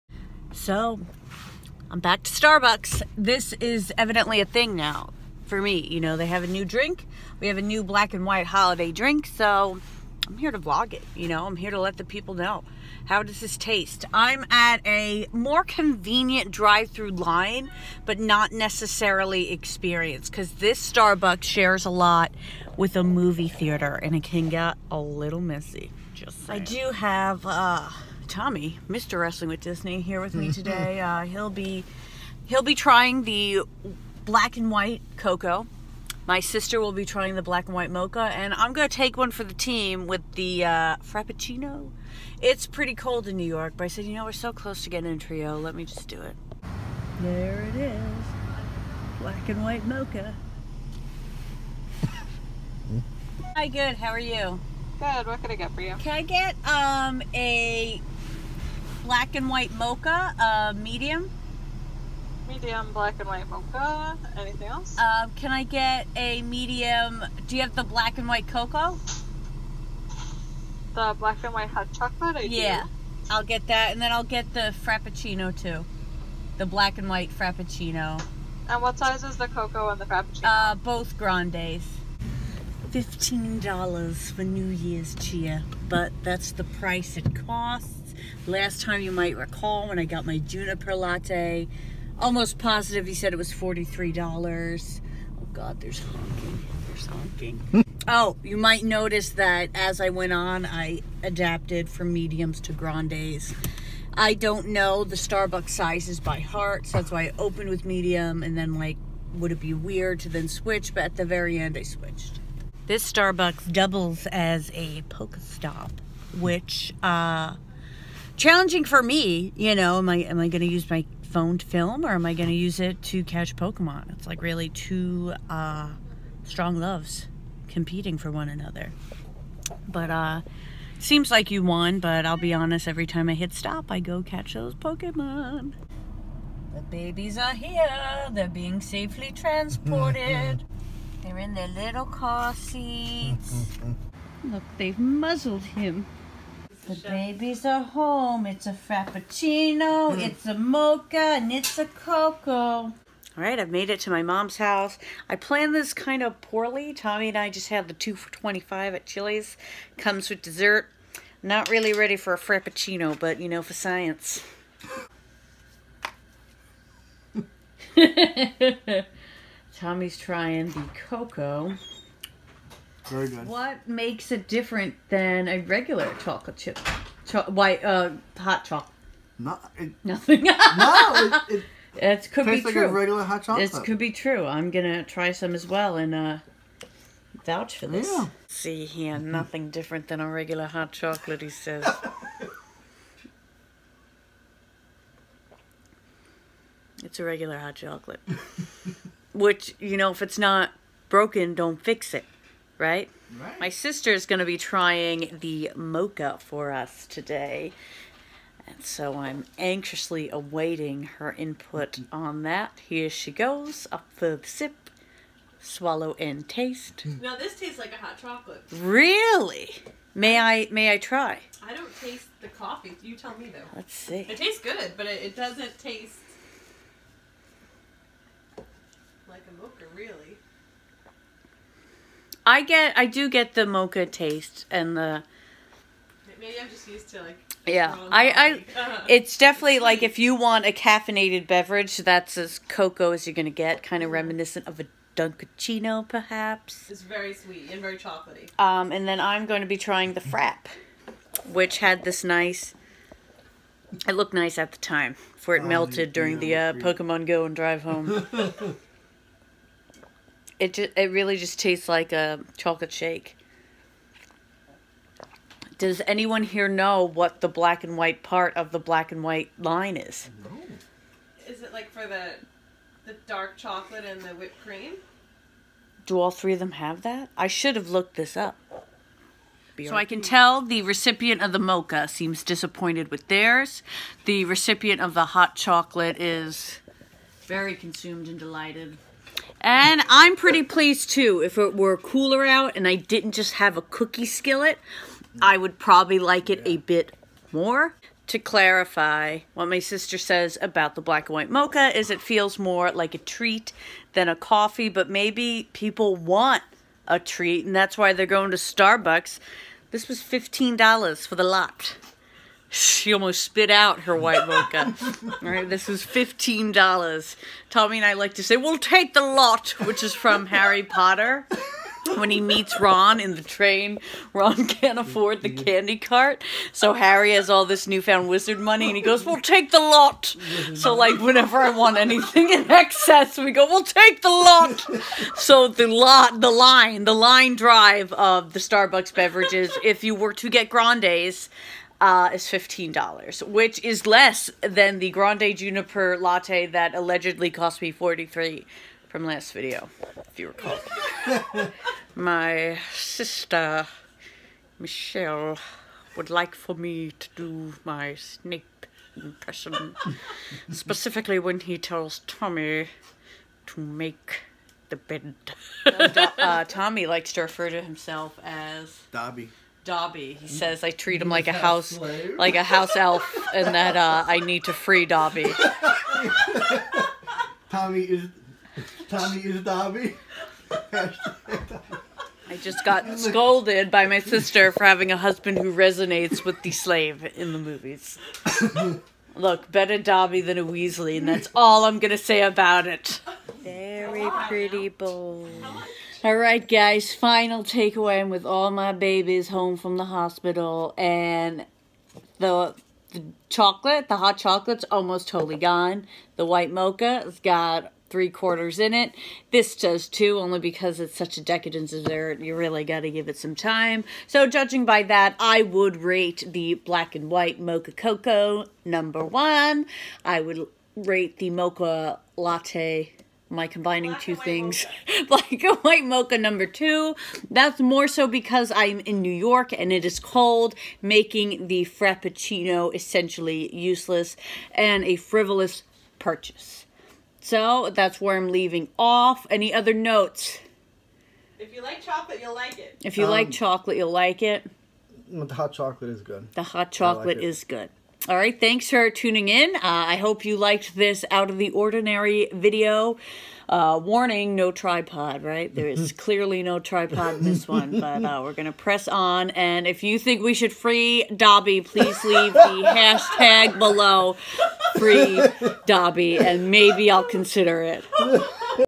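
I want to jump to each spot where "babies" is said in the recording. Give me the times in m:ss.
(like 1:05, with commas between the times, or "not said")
2:16, 2:26, 6:38.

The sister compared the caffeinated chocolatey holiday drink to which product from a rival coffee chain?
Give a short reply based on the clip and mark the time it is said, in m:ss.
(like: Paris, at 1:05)
Dunkaccino, at 4:05.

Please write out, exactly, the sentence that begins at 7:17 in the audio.
So that's where I'm leaving off.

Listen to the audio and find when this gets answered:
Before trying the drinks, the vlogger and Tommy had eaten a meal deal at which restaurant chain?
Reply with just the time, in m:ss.
2:39.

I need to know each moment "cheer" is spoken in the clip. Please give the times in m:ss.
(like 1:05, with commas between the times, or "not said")
1:25.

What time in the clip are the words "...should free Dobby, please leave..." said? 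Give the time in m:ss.
7:40.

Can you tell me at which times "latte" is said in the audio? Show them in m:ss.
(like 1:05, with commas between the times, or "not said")
1:30, 5:46, 7:02.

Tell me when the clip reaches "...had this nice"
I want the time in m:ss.
4:11.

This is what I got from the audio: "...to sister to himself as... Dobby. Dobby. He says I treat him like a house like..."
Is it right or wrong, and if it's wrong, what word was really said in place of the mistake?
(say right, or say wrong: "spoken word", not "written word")
wrong: "refer", not "sister".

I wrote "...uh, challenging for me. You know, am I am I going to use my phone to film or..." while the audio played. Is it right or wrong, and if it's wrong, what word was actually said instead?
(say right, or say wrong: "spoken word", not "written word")
right.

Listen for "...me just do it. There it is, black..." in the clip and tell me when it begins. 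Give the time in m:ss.
0:45.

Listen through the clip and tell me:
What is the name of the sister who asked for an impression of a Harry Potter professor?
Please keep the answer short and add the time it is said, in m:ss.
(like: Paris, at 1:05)
Michelle, at 5:54.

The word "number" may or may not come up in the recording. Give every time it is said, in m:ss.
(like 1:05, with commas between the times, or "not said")
6:58, 7:06.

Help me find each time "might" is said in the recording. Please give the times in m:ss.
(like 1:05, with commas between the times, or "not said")
1:29, 1:38.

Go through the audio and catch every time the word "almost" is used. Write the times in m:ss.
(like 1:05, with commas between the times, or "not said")
1:32, 5:13, 6:44.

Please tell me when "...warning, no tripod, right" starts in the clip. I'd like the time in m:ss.
7:34.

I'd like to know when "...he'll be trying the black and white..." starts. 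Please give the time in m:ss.
0:32.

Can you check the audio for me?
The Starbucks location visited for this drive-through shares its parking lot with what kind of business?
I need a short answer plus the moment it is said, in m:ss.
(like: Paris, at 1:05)
movie theater, at 0:23.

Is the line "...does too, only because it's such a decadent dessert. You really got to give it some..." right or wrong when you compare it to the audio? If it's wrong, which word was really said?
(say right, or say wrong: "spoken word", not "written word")
right.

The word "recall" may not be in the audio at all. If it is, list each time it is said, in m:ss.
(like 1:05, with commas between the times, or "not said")
1:29, 5:50.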